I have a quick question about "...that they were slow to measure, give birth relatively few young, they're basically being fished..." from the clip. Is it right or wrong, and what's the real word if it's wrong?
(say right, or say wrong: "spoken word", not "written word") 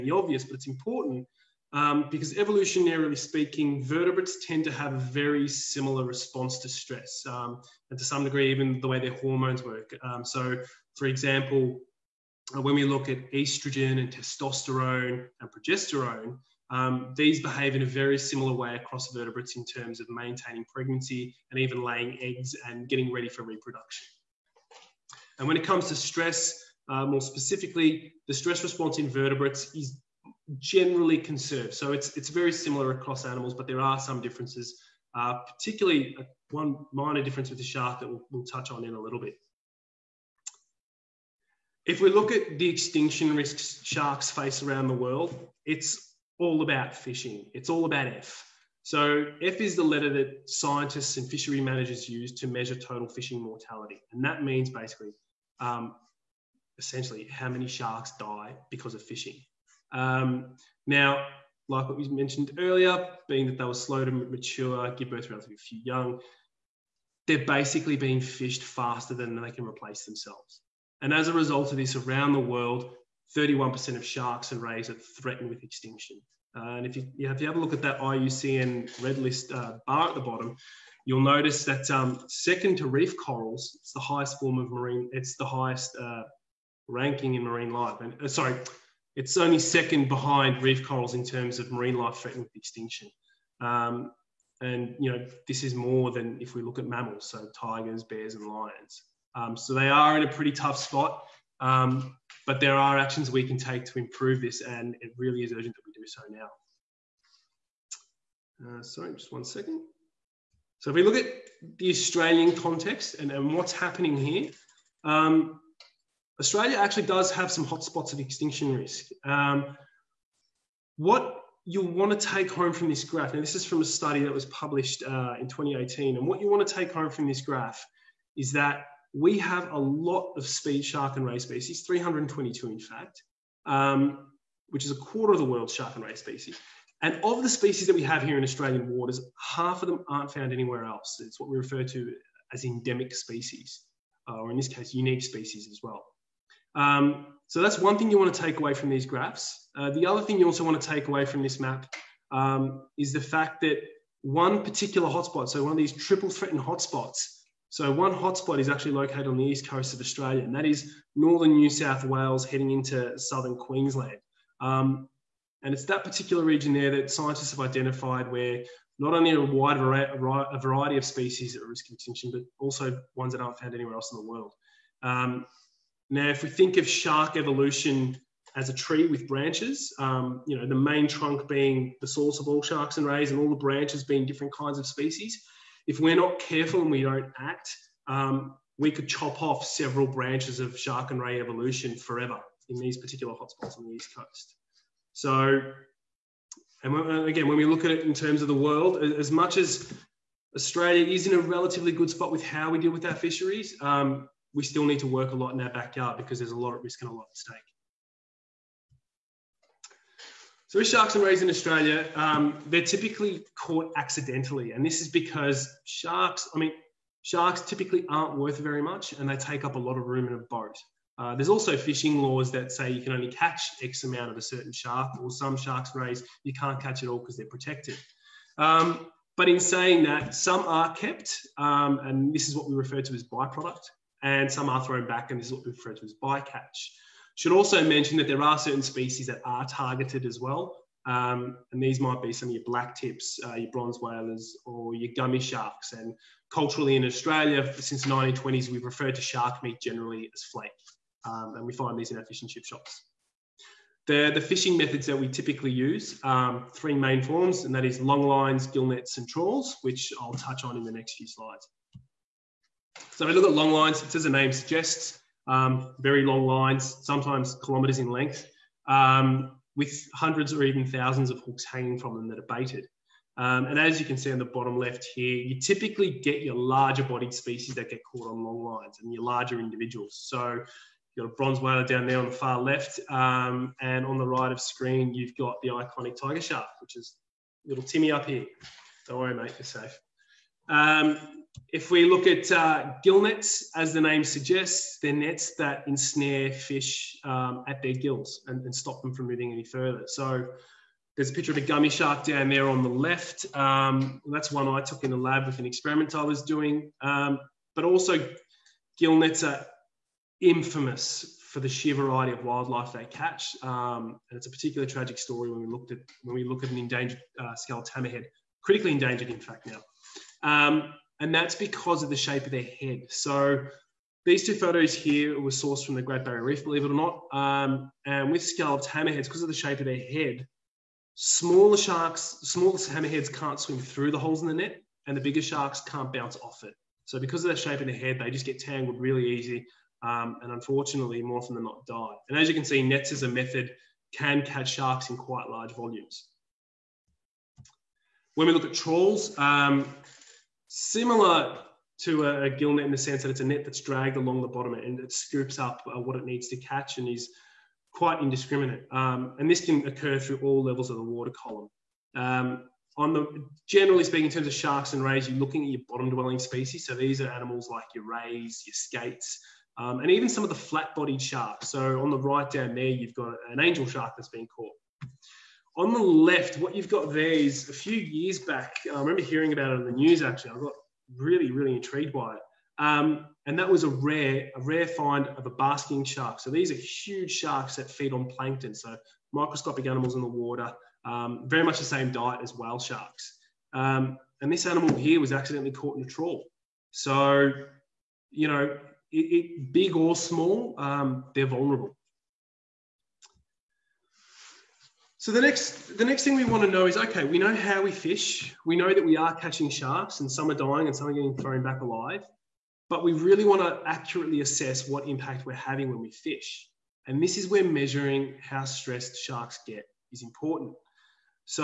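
wrong: "mature", not "measure".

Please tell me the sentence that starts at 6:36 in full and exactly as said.
So, you know, it, it, big or small, um, they're vulnerable.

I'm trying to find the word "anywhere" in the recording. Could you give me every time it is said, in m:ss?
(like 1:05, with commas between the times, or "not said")
2:20, 2:53.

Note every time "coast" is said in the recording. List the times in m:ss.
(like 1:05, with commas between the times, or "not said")
2:39, 3:14.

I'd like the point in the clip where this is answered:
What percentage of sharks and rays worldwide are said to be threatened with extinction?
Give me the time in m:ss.
1:13.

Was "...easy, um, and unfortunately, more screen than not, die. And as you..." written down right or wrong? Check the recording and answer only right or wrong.
wrong.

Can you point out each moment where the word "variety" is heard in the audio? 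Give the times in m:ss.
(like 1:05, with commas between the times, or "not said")
2:50, 5:11.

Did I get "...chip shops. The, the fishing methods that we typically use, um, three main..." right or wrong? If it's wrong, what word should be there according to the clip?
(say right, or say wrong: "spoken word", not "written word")
right.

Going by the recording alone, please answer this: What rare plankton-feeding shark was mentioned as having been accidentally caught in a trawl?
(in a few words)
Basking shark.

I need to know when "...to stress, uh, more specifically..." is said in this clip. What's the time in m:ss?
0:25.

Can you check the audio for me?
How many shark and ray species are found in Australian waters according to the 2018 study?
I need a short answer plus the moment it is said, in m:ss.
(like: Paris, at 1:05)
322, at 2:11.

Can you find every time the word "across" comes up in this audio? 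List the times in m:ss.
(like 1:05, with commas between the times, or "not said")
0:18, 0:32.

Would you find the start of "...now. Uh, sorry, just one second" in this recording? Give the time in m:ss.
1:48.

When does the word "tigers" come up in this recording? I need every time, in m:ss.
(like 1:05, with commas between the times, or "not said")
1:37, 4:46.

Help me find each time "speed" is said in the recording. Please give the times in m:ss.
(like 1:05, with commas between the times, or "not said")
2:10.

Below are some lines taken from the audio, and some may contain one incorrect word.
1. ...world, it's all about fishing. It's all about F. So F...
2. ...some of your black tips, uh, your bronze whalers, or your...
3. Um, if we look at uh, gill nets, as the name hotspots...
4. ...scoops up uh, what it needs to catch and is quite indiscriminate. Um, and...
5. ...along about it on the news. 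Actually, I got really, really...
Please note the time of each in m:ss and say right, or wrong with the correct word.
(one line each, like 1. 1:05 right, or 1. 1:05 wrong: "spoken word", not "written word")
1. 0:44 right
2. 4:02 right
3. 4:50 wrong: "suggests", not "hotspots"
4. 5:55 right
5. 6:19 wrong: "hearing", not "along".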